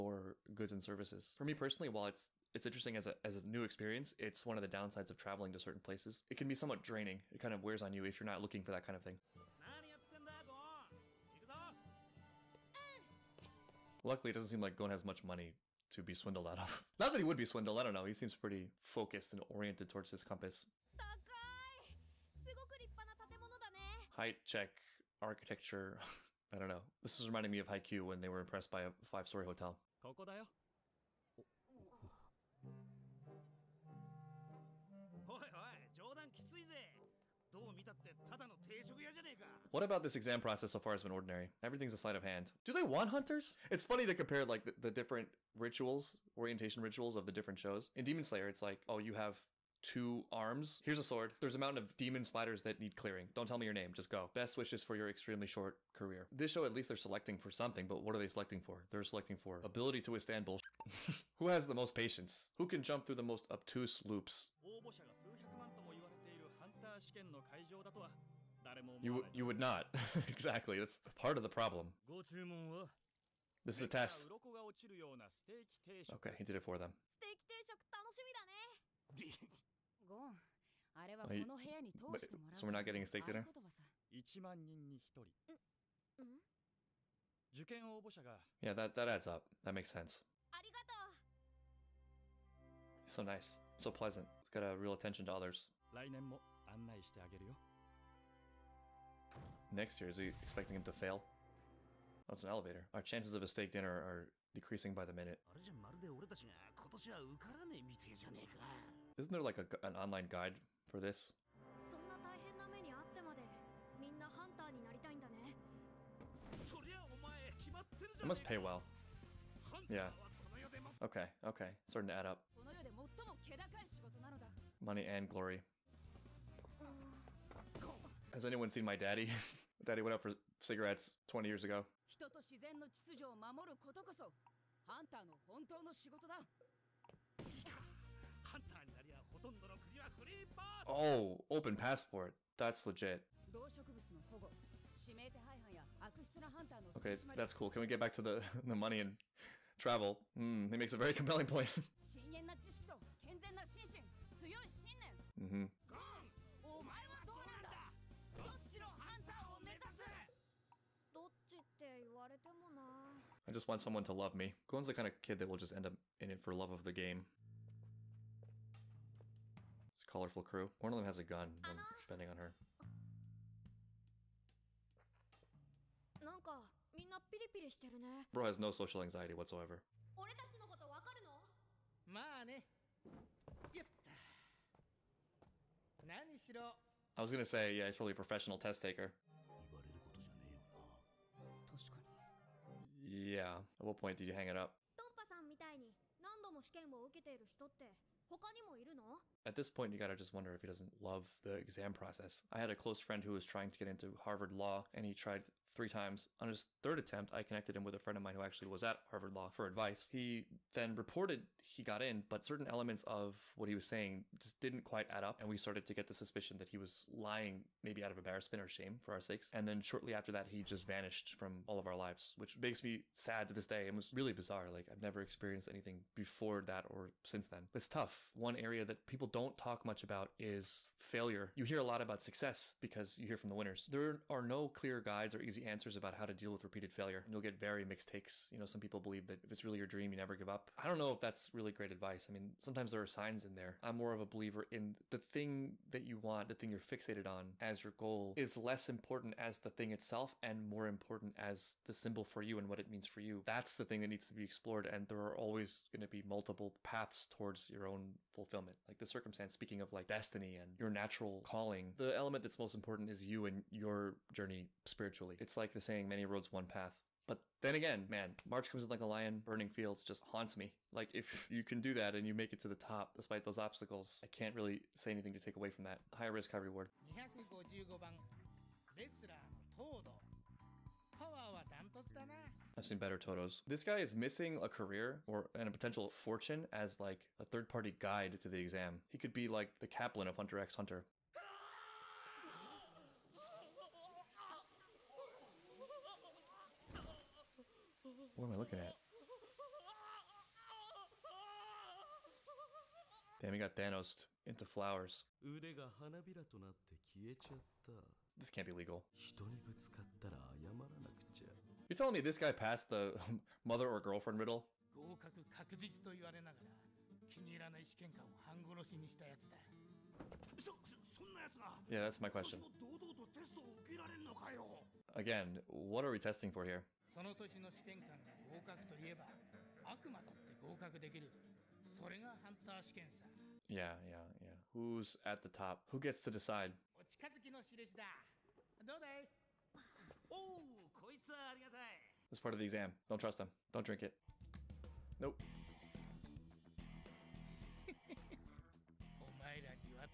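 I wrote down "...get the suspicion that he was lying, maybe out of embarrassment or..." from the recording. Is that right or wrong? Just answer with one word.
right.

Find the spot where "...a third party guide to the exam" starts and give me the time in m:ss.
4:47.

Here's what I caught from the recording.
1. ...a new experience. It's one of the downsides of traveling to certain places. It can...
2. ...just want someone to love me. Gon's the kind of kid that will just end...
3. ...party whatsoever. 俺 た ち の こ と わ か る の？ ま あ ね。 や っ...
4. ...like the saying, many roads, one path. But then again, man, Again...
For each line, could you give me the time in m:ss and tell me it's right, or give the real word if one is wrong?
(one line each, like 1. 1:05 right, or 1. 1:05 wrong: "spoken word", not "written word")
1. 0:03 right
2. 2:43 right
3. 2:59 wrong: "anxiety", not "party"
4. 4:25 wrong: "March", not "Again".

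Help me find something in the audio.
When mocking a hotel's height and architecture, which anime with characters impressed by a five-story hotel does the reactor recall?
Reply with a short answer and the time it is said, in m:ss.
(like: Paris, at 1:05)
Haikyuu, at 0:27.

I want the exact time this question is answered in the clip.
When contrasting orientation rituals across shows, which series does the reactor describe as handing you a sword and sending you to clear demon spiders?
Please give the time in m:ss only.
0:48.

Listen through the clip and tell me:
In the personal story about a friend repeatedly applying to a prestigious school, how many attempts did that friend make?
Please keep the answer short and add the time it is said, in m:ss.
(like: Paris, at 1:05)
3, at 3:25.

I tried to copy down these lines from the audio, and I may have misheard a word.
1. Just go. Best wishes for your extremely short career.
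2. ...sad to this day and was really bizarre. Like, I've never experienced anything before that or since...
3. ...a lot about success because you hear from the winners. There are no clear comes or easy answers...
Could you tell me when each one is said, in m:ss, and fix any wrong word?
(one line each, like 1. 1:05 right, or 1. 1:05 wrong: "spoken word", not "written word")
1. 0:53 right
2. 3:43 right
3. 3:51 wrong: "guides", not "comes".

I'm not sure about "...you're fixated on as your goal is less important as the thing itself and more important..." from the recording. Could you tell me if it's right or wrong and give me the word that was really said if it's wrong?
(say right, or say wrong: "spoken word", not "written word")
right.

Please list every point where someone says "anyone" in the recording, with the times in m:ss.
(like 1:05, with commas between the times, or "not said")
2:08.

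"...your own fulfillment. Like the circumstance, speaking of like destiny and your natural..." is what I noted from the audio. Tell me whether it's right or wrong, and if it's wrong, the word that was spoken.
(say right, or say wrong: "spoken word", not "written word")
right.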